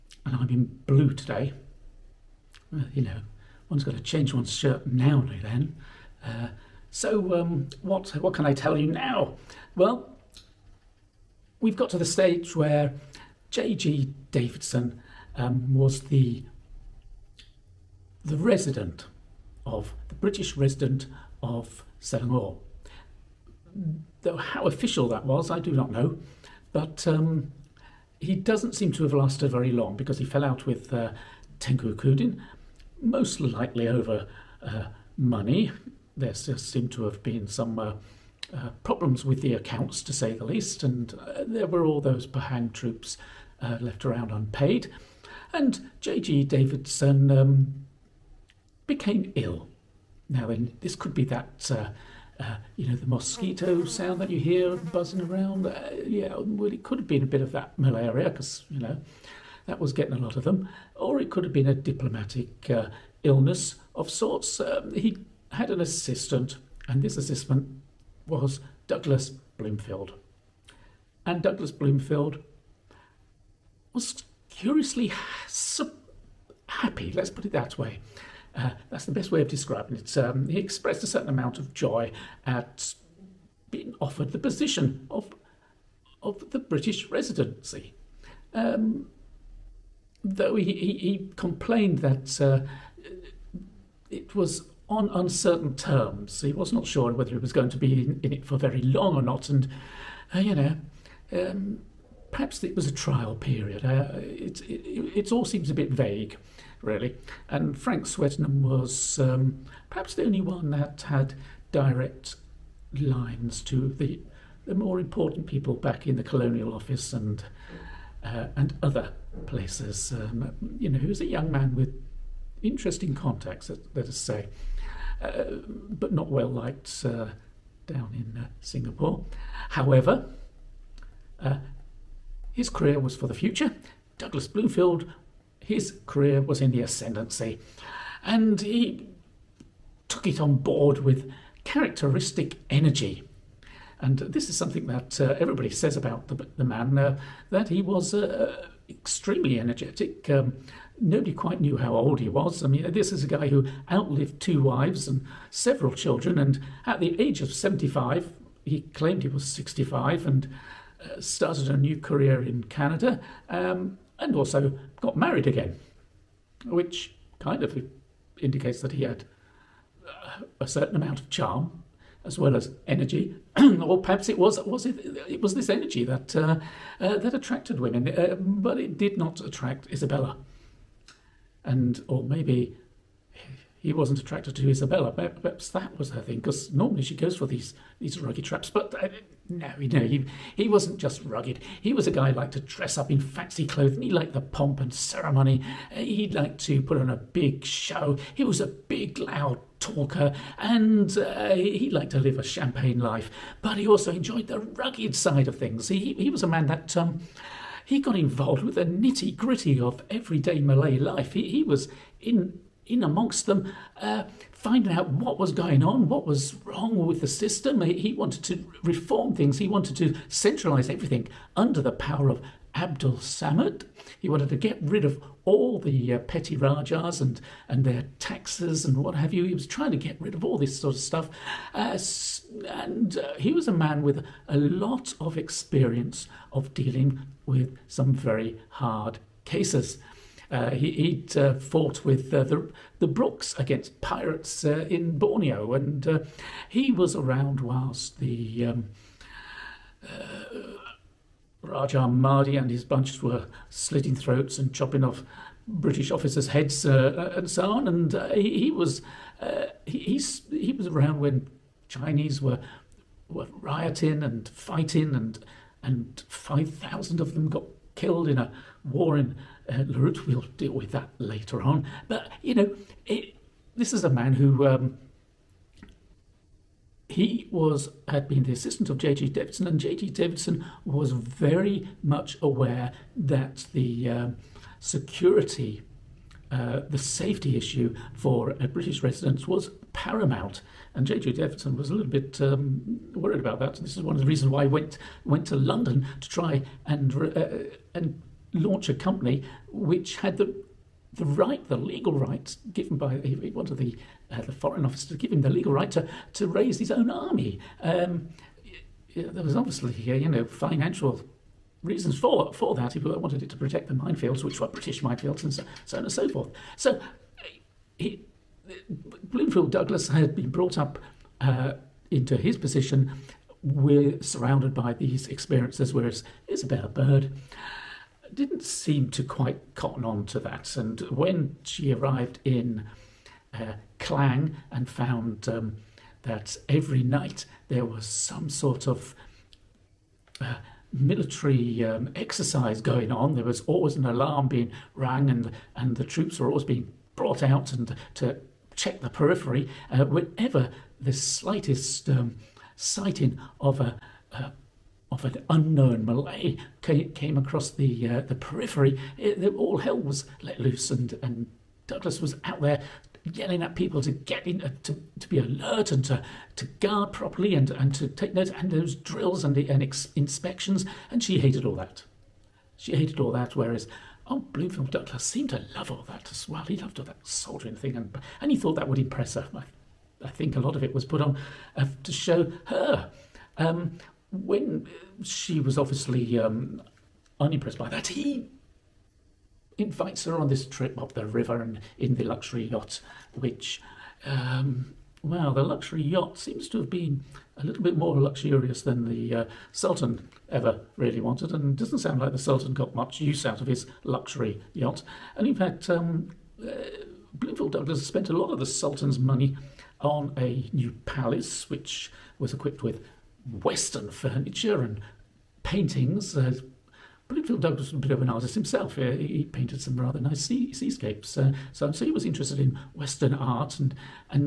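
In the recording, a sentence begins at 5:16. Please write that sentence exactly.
So uh, he, Bloomfield Douglas had been brought up uh, into his position.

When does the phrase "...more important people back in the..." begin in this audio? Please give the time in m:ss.
1:54.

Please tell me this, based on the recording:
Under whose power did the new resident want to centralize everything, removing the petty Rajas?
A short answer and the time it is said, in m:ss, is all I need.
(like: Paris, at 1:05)
Abdul Samad, at 3:42.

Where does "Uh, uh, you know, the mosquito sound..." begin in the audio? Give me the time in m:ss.
0:51.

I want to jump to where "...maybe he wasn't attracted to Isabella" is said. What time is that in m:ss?
3:02.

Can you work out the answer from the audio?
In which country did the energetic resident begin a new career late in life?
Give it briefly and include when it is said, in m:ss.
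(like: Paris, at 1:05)
Canada, at 2:42.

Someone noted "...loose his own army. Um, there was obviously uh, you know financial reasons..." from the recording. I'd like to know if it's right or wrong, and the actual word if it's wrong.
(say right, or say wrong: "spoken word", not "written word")
wrong: "raise", not "loose".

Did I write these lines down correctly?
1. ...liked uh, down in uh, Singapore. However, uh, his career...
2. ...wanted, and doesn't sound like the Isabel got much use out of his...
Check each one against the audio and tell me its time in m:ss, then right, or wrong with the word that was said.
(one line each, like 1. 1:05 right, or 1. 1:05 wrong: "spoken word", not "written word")
1. 2:06 right
2. 6:41 wrong: "Sultan", not "Isabel".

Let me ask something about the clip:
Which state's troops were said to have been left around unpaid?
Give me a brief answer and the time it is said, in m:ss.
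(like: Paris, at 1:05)
Pahang, at 0:42.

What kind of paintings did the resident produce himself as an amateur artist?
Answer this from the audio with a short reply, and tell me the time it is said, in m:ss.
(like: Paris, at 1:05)
seascapes, at 7:00.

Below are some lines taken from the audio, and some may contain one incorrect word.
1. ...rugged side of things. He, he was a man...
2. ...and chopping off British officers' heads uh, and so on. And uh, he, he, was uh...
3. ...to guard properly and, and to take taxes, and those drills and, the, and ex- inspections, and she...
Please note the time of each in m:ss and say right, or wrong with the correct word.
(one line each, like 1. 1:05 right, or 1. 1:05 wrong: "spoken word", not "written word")
1. 3:24 right
2. 4:14 right
3. 6:06 wrong: "notes", not "taxes".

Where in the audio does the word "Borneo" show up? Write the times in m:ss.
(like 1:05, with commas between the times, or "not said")
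4:05.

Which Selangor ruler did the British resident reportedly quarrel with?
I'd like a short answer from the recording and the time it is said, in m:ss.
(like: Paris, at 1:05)
Tengku Kudin, at 0:31.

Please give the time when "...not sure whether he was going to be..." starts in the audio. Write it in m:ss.
1:36.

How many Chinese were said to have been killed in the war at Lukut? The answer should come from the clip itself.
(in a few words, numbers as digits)
5000.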